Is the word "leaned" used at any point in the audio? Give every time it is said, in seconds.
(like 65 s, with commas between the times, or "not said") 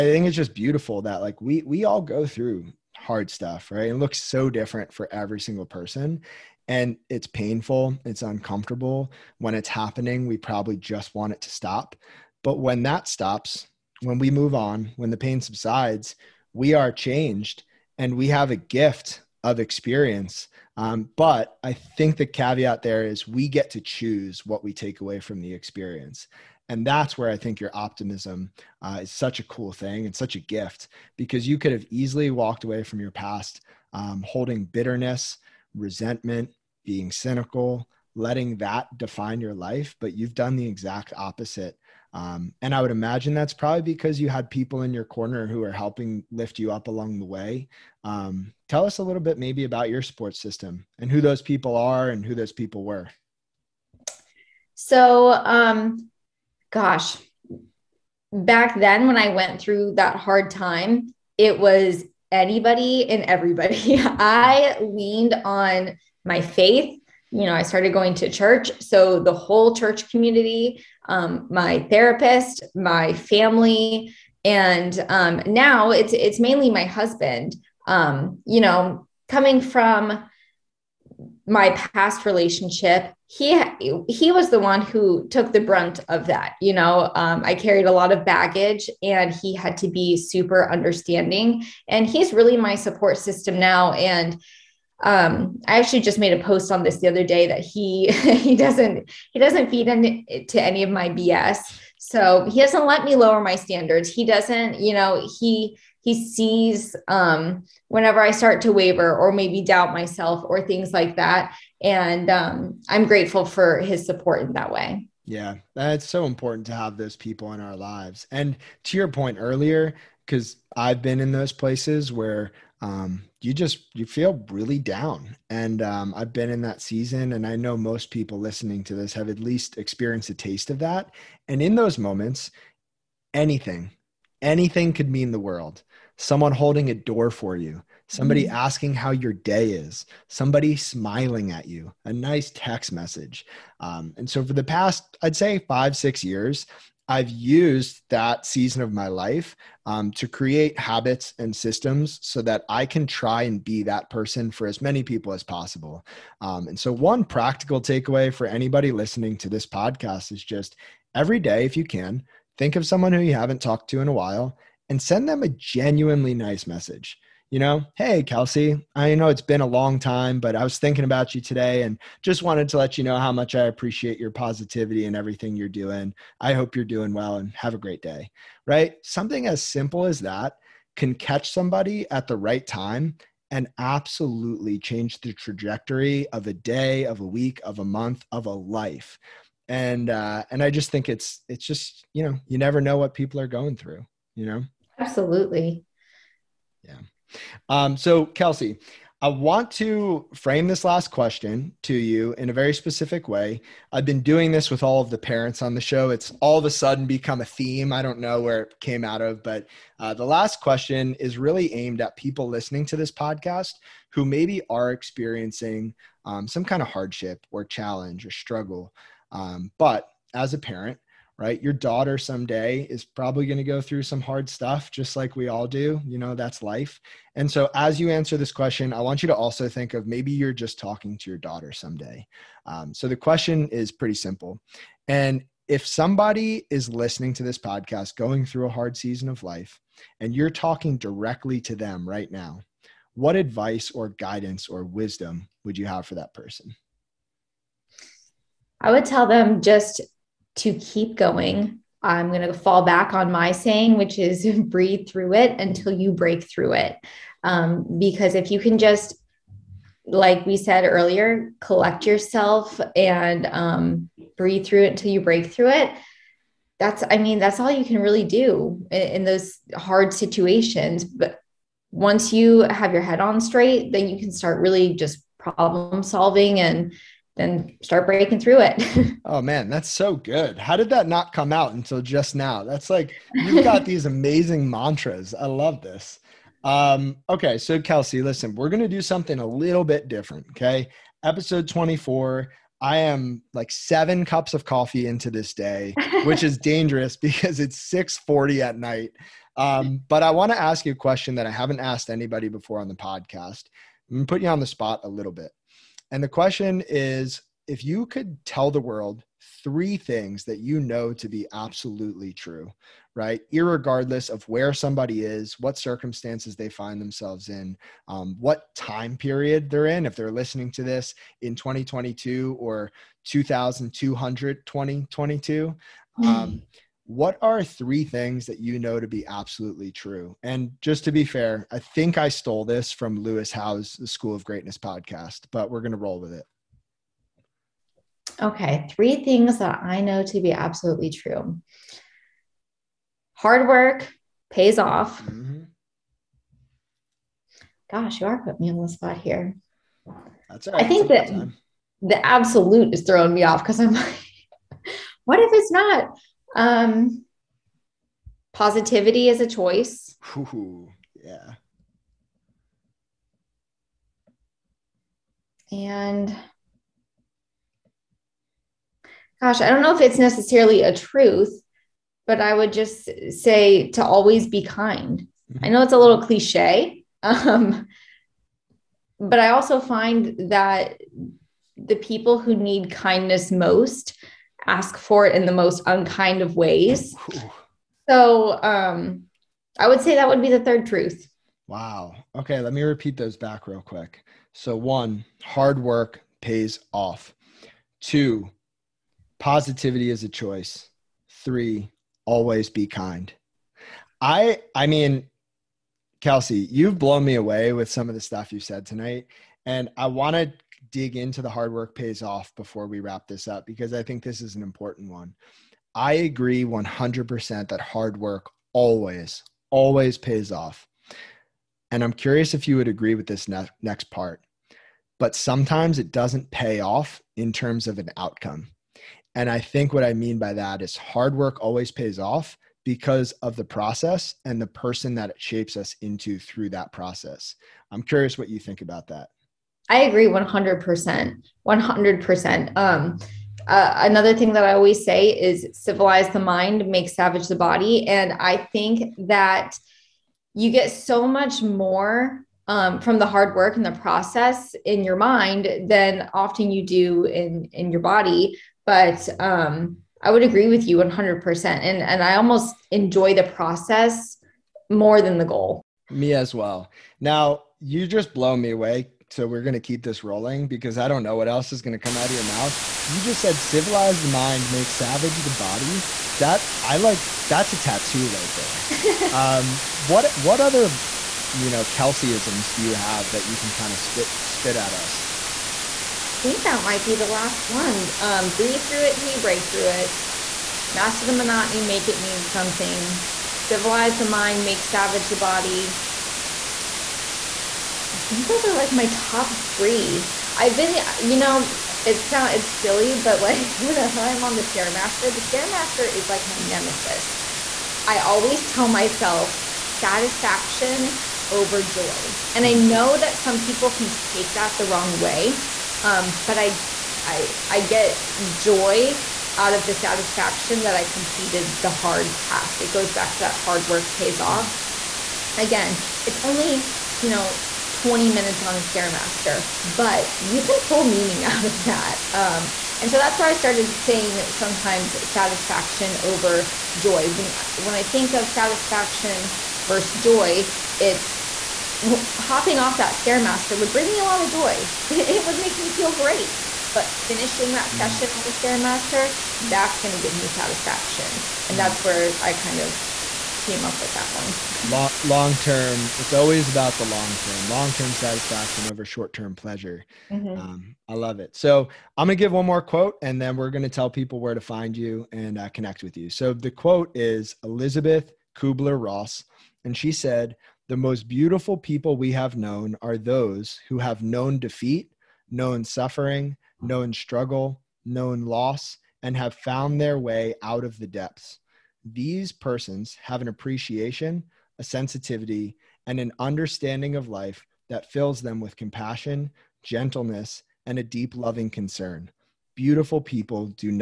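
64 s.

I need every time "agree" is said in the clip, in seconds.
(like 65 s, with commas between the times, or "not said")
416 s, 422 s, 440 s, 460 s.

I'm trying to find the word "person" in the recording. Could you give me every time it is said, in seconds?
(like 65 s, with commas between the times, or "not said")
5 s, 154 s, 246 s, 434 s, 582 s.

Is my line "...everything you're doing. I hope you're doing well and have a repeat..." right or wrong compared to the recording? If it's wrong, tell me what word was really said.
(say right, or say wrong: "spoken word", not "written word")
wrong: "great", not "repeat".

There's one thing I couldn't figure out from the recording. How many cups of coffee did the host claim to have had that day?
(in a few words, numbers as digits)
7.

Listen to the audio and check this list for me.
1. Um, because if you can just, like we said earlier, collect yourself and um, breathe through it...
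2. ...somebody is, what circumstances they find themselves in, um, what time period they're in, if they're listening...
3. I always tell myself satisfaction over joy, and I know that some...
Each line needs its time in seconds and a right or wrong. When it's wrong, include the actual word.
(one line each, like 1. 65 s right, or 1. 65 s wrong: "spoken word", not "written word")
1. 257 s right
2. 314 s right
3. 508 s right.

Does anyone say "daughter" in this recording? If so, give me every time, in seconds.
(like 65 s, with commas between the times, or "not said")
221 s, 231 s.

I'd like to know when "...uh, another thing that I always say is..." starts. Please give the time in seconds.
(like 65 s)
443 s.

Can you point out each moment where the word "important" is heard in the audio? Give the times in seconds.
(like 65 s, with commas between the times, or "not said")
116 s, 414 s.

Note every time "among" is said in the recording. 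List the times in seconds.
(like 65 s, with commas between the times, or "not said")
not said.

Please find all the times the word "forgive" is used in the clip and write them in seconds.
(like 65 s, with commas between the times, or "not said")
not said.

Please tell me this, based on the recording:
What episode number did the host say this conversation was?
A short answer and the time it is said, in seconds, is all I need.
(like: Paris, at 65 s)
24, at 291 s.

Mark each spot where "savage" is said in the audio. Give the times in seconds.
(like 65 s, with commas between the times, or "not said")
447 s, 474 s, 494 s.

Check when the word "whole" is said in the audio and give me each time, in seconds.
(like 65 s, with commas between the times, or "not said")
69 s.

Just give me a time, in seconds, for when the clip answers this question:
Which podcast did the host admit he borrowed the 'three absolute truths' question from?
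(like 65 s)
333 s.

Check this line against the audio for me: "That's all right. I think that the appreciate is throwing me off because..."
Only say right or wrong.
wrong.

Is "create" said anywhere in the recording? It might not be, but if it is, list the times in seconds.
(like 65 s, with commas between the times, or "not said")
150 s.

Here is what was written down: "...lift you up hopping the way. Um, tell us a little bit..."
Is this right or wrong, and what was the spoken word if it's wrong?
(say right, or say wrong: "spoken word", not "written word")
wrong: "along", not "hopping".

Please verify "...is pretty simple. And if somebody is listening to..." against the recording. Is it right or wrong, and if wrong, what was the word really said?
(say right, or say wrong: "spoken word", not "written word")
right.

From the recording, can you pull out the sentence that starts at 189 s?
And uh, and I just think it's it's just you know you never know what people are going through, you know.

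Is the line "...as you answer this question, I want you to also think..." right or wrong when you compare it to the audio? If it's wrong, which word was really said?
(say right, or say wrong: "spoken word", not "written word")
right.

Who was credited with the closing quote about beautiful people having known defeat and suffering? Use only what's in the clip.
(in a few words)
Elizabeth Kubler Ross.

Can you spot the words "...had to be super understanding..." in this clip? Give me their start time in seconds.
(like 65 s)
89 s.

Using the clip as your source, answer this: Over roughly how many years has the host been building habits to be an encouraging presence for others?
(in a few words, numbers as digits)
5 or 6 years.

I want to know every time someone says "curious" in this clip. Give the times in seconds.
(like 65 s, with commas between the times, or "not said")
422 s, 438 s.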